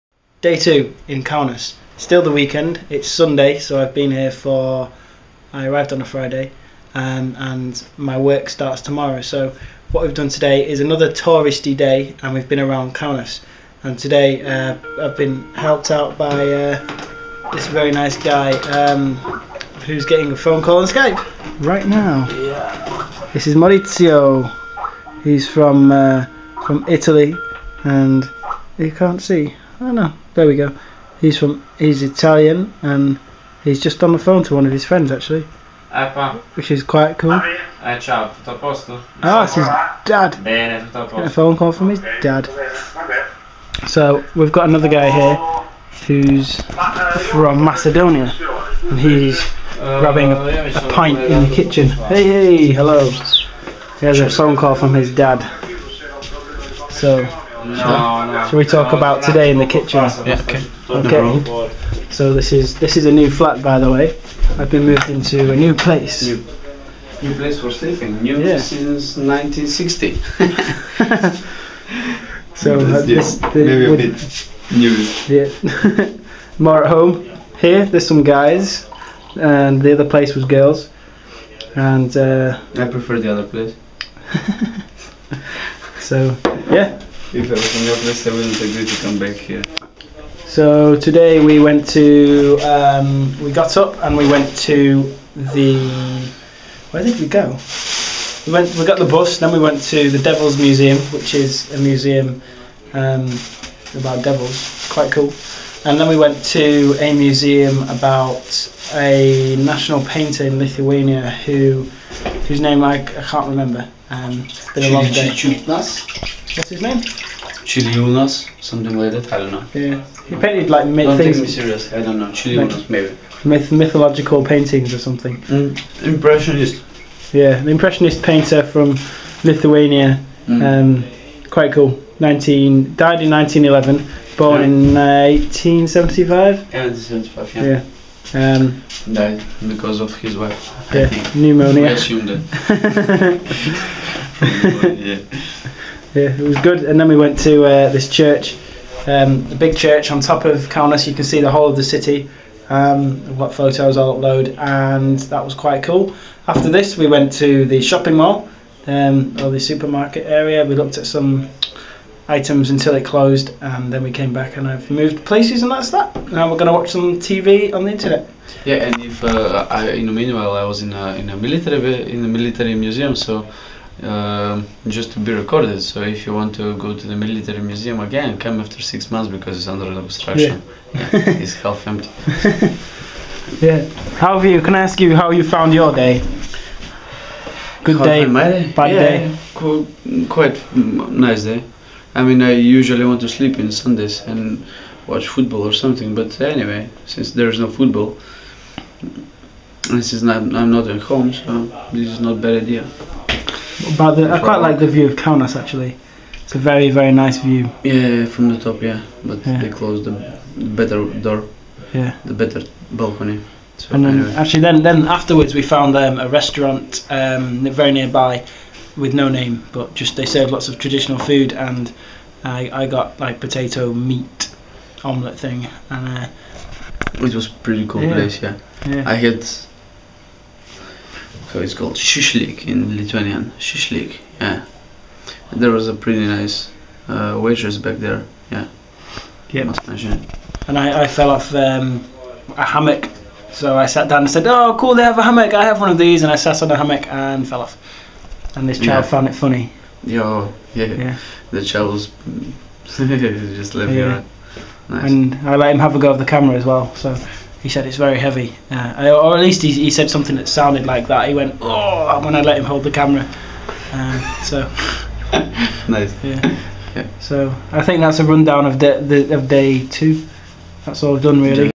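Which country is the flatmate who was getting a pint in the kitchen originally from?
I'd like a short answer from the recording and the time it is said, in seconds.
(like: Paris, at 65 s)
Macedonia, at 47 s.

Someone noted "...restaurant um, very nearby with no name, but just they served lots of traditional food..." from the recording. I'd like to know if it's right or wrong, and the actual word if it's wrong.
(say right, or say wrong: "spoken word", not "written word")
right.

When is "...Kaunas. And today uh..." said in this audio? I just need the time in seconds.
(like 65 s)
12 s.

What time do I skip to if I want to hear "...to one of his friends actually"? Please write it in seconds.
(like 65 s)
34 s.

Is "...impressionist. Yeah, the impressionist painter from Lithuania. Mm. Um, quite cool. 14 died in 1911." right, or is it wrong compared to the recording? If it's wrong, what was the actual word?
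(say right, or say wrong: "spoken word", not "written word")
wrong: "19", not "14".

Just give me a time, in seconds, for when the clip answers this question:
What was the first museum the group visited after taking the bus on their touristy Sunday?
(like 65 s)
100 s.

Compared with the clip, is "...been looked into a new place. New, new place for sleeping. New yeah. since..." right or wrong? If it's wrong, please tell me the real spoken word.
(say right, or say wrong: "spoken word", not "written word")
wrong: "moved", not "looked".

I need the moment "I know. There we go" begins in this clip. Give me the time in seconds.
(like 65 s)
29 s.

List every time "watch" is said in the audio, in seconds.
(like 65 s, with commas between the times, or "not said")
166 s, 195 s.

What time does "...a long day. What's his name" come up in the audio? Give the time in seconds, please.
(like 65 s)
114 s.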